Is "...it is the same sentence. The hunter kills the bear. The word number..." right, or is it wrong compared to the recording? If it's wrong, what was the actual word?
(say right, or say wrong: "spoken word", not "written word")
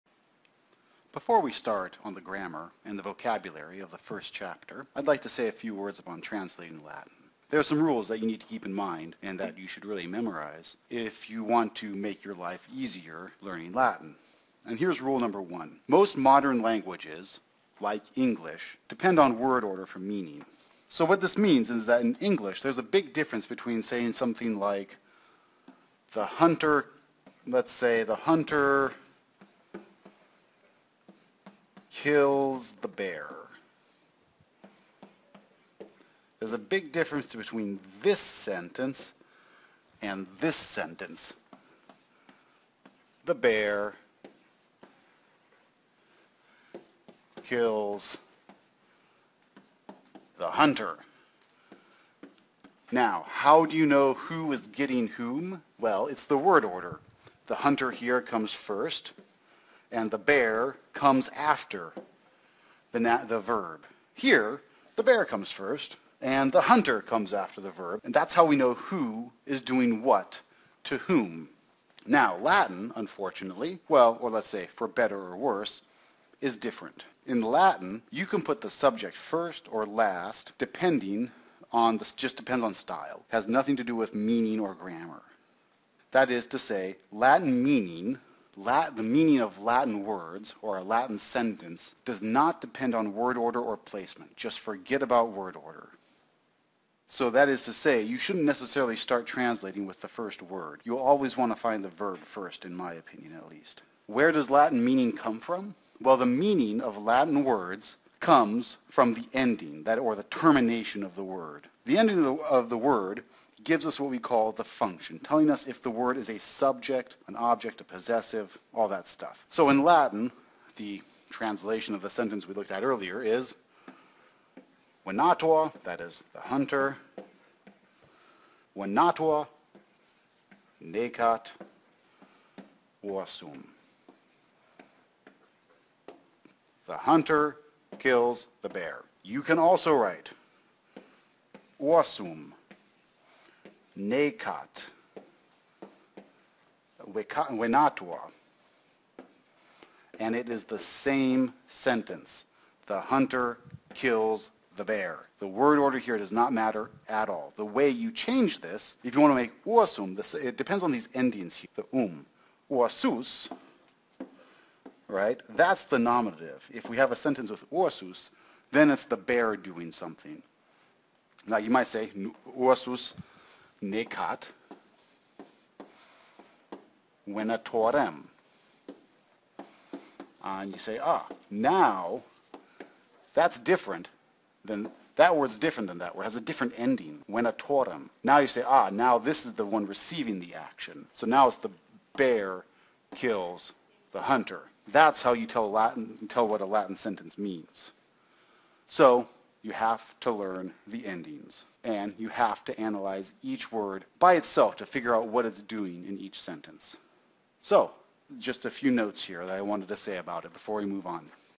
wrong: "order", not "number".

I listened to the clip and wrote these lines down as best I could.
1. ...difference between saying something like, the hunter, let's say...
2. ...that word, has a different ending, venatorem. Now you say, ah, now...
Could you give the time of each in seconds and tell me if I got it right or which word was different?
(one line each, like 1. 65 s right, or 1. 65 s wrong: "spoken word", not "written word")
1. 23 s right
2. 185 s right.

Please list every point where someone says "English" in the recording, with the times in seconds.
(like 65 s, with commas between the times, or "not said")
18 s, 22 s.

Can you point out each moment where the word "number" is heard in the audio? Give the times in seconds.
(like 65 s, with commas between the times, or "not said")
15 s.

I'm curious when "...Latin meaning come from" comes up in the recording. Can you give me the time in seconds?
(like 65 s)
104 s.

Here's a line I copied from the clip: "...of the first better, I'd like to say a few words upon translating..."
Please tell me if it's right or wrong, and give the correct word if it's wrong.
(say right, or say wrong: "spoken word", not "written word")
wrong: "chapter", not "better".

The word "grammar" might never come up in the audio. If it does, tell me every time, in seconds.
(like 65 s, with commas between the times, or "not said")
2 s, 84 s.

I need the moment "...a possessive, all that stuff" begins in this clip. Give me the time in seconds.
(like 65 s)
117 s.